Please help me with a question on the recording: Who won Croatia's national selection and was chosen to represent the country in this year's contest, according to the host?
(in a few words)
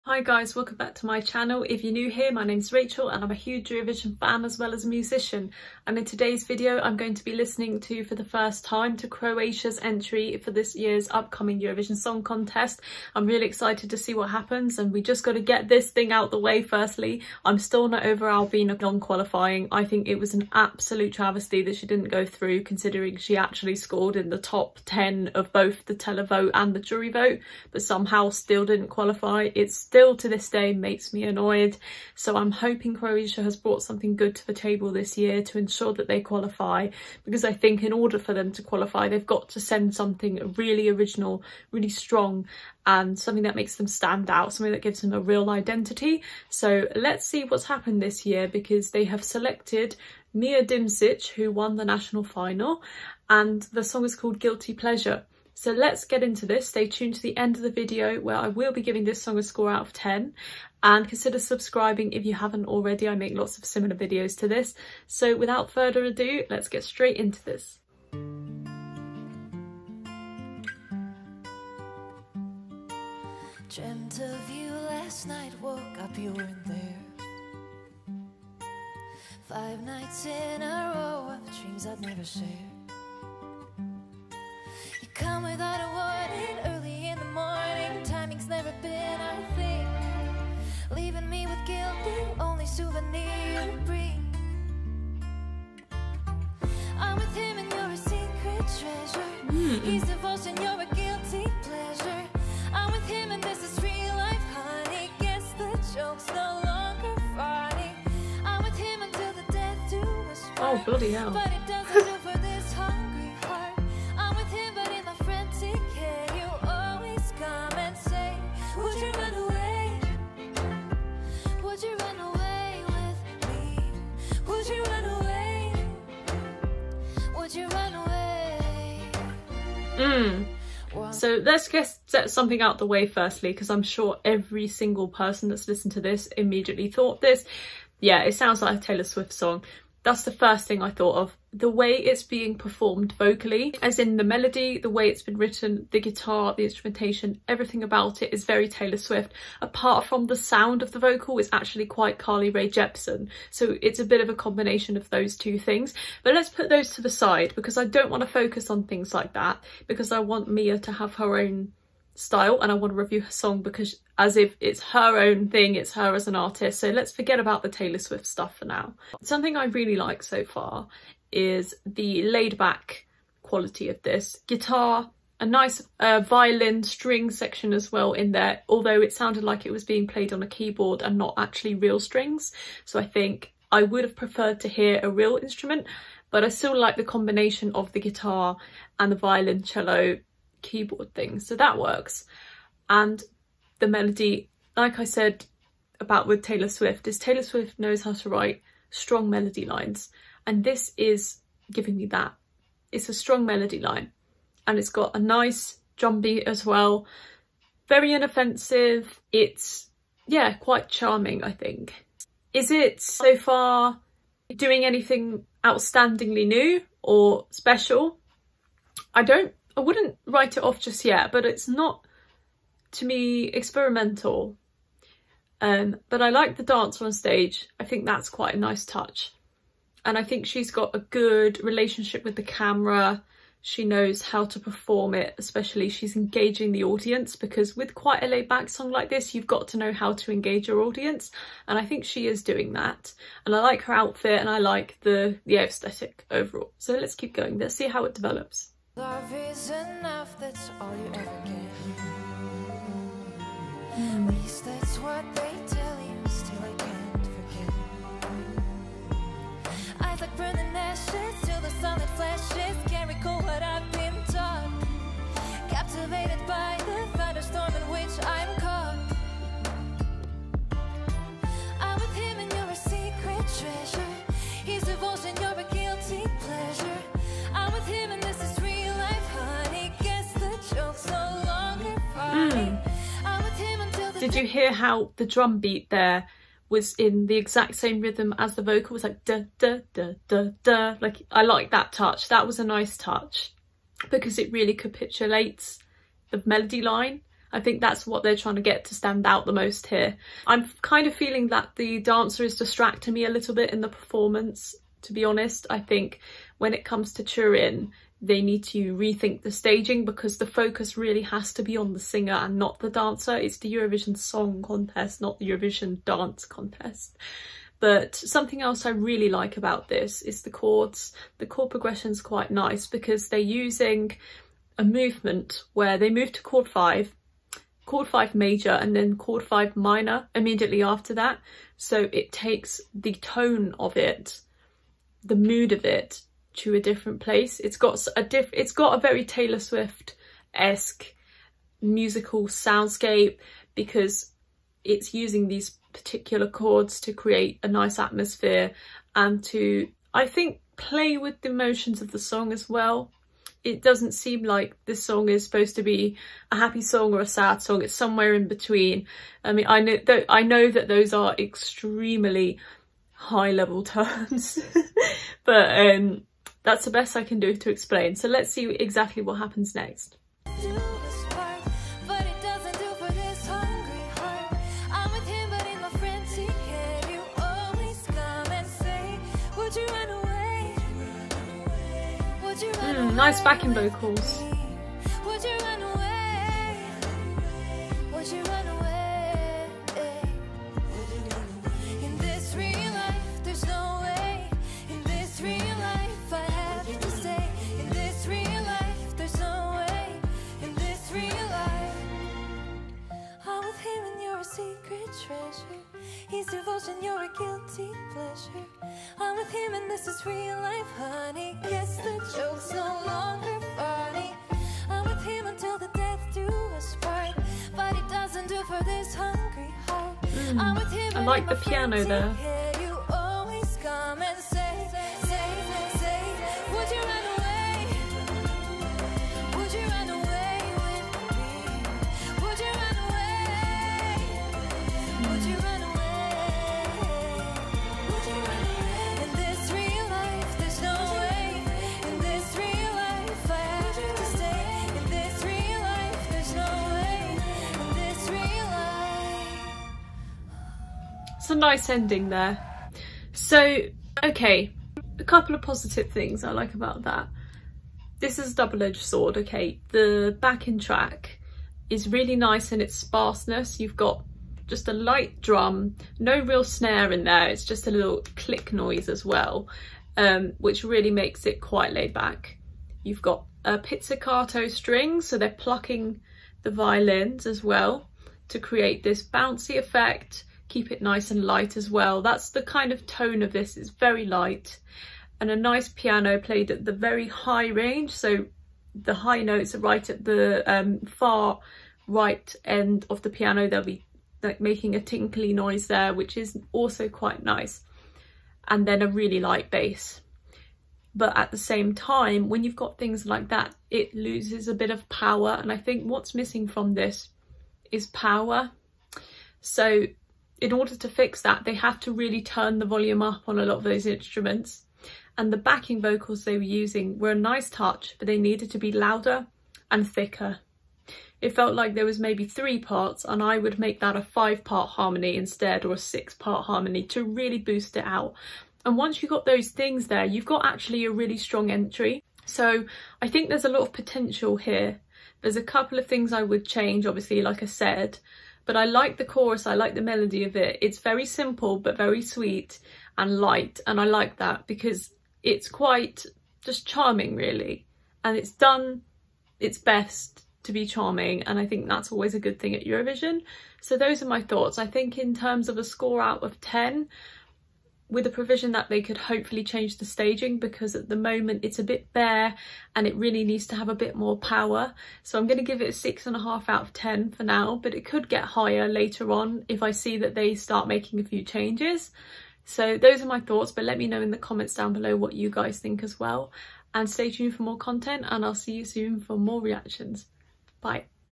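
Mia Dimšić.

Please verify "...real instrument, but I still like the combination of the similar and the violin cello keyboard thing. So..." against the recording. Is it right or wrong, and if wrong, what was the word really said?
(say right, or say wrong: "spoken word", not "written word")
wrong: "guitar", not "similar".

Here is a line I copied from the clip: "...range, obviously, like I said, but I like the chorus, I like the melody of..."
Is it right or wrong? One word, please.
wrong.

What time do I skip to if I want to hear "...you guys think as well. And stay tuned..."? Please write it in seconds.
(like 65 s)
575 s.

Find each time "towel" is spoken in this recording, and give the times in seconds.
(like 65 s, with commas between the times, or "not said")
not said.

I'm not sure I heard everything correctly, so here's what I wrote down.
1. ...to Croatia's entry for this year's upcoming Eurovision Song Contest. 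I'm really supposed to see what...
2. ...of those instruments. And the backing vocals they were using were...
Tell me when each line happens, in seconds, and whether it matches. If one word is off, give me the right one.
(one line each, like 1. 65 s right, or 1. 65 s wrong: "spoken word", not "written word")
1. 8 s wrong: "excited", not "supposed"
2. 513 s right.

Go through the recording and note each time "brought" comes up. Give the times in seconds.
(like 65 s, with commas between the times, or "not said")
33 s.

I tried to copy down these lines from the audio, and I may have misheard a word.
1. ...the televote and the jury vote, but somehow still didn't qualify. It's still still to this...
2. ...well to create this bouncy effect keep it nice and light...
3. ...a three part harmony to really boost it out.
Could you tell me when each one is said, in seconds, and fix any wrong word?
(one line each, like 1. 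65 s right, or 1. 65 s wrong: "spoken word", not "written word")
1. 25 s right
2. 477 s right
3. 525 s wrong: "six", not "three".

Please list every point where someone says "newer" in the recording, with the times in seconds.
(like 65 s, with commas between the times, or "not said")
not said.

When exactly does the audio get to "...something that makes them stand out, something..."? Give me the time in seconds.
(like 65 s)
43 s.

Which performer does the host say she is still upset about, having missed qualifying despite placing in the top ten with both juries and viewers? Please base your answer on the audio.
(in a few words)
Albina.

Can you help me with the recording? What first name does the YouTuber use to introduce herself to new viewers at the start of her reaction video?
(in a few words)
Rachel.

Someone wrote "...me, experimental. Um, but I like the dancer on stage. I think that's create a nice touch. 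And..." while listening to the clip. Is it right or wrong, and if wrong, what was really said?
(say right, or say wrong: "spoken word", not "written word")
wrong: "quite", not "create".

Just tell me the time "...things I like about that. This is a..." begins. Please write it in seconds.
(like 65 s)
456 s.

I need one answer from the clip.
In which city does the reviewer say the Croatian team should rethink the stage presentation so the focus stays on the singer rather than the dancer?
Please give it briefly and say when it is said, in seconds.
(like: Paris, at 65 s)
Turin, at 307 s.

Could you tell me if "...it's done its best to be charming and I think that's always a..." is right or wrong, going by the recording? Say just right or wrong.
right.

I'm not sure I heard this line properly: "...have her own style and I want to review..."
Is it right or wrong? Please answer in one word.
right.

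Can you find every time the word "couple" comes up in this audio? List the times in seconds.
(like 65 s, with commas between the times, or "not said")
455 s, 535 s.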